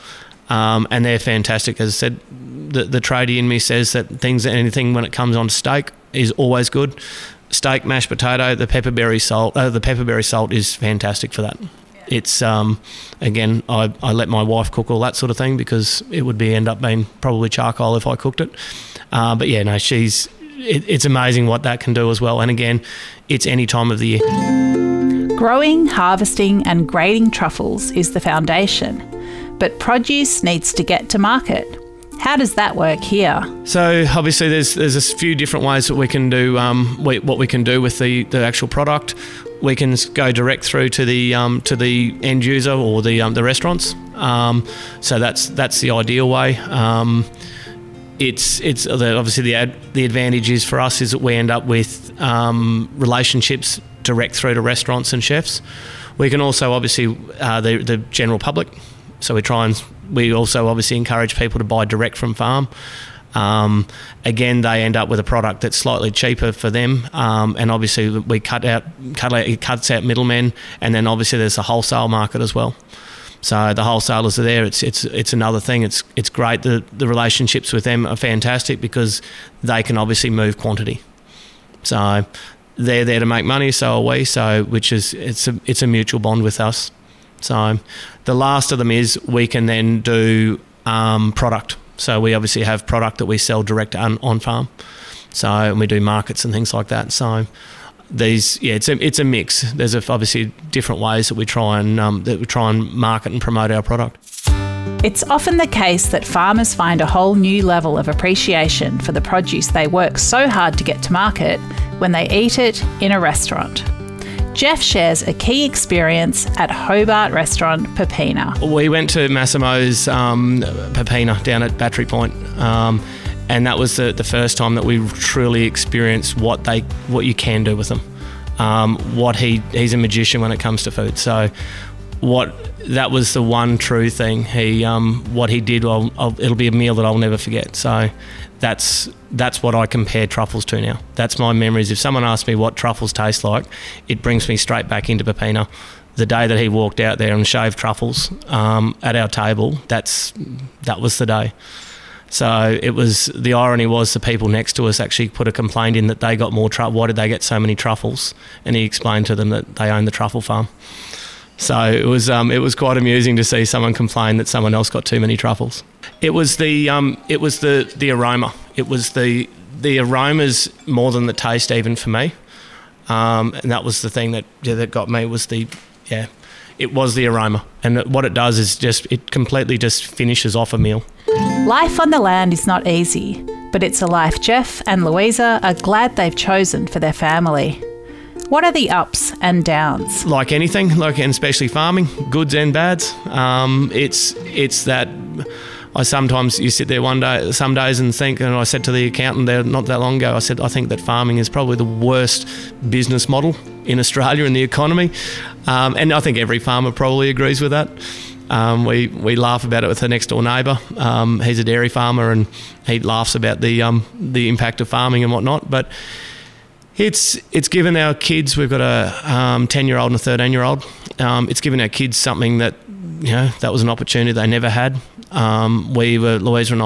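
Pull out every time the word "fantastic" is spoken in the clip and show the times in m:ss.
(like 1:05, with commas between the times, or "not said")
0:01, 0:10, 1:18.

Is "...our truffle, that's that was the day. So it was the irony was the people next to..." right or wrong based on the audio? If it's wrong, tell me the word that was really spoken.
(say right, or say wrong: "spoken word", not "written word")
wrong: "table", not "truffle".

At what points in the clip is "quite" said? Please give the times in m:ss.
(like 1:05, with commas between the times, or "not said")
2:42.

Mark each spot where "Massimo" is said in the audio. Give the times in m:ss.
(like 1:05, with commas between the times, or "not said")
1:59.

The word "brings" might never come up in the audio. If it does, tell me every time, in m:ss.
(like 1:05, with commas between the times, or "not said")
2:24.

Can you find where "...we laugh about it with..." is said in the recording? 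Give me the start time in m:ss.
3:29.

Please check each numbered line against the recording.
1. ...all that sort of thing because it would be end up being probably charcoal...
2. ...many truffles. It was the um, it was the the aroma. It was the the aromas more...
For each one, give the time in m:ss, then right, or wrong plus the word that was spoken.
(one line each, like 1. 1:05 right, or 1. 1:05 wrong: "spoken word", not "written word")
1. 0:14 right
2. 2:45 right.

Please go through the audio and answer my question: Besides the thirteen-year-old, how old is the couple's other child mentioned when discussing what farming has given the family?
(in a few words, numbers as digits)
10.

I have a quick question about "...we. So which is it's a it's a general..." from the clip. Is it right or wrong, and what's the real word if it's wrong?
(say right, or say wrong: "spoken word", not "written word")
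wrong: "mutual", not "general".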